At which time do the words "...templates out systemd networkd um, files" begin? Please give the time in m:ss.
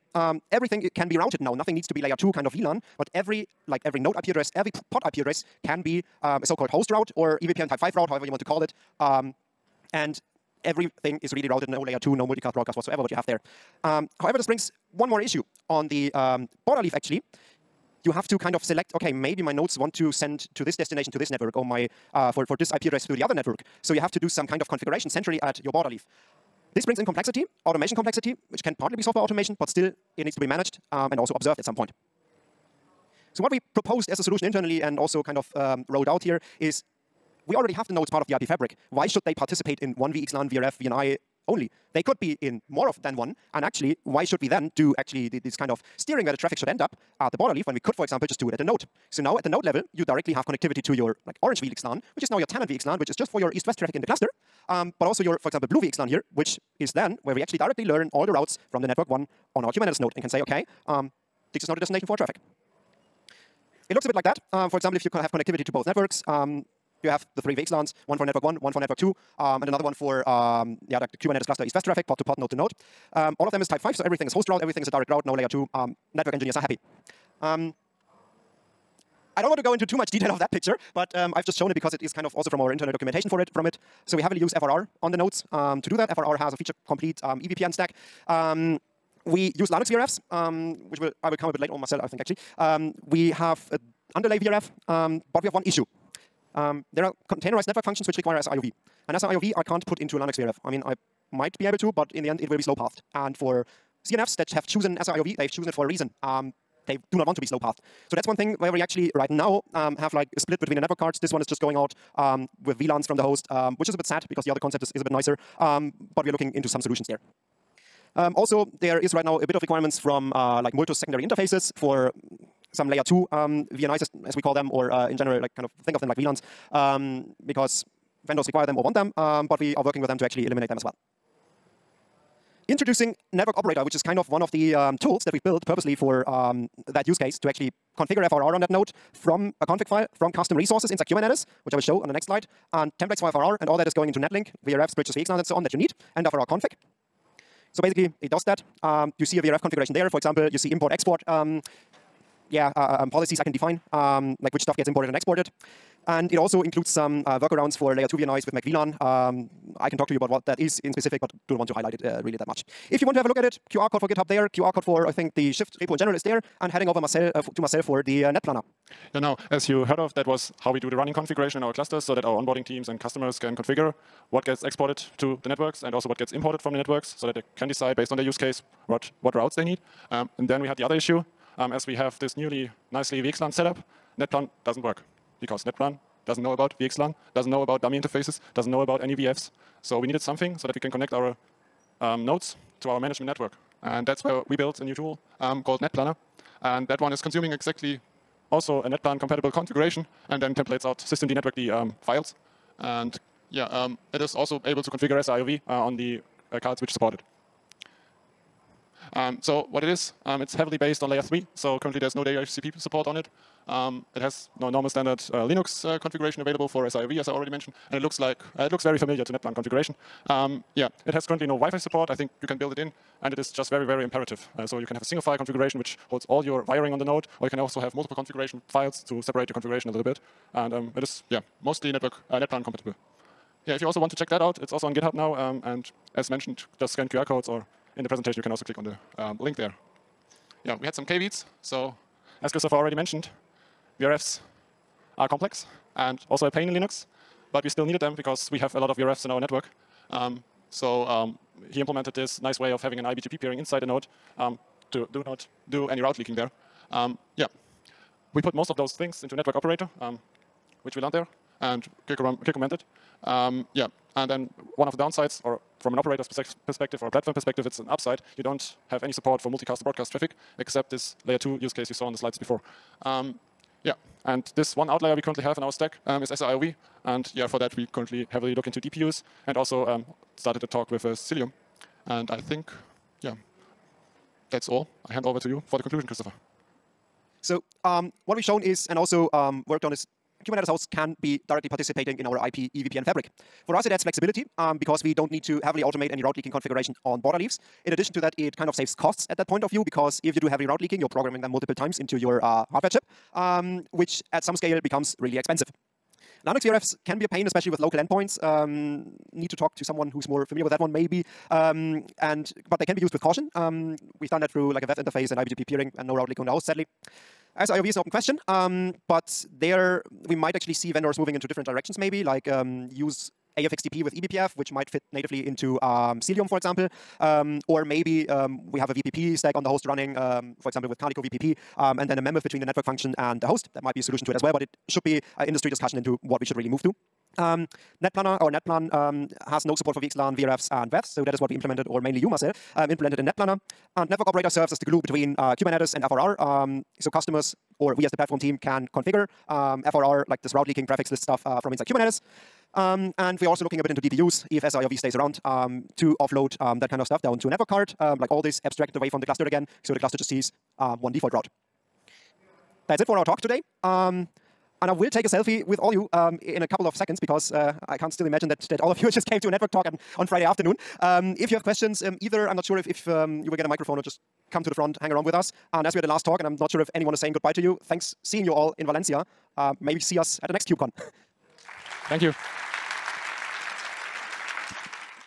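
3:20.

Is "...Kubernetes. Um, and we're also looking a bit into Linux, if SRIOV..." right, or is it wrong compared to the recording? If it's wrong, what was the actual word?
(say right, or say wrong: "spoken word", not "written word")
wrong: "DPUs", not "Linux".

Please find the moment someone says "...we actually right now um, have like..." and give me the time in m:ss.
1:48.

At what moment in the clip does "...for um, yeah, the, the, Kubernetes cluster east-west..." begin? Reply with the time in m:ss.
1:09.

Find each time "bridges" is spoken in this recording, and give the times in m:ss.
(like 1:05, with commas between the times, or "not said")
2:24.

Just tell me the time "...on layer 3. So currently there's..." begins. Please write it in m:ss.
3:31.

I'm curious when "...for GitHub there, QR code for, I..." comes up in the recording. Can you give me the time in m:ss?
2:44.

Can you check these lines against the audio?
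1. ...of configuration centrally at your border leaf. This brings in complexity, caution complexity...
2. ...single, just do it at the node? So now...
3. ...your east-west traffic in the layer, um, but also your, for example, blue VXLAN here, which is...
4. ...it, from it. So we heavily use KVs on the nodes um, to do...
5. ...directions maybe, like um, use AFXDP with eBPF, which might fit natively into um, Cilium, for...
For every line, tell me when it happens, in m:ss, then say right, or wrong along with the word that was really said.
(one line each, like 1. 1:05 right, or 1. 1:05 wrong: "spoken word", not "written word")
1. 0:24 wrong: "automation", not "caution"
2. 0:48 wrong: "example", not "single"
3. 0:53 wrong: "cluster", not "layer"
4. 1:23 wrong: "FRR", not "KVs"
5. 5:21 right.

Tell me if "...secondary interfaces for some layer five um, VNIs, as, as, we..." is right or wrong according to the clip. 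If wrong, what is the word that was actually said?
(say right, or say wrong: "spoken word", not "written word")
wrong: "two", not "five".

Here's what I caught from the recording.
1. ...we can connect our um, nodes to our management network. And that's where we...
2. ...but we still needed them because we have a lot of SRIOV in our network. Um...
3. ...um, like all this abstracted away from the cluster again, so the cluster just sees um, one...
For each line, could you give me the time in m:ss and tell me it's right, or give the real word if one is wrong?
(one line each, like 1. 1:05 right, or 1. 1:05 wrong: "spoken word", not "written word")
1. 3:10 right
2. 4:07 wrong: "VRFs", not "SRIOV"
3. 5:57 right.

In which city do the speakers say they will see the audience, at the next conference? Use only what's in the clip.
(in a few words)
Valencia.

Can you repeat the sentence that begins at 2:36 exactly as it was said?
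And it also includes some uh, workarounds for layer 2 VNIs with MacVLAN.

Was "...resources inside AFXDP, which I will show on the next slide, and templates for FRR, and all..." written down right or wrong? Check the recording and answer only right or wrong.
wrong.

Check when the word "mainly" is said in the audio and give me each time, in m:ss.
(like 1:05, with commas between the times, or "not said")
5:42.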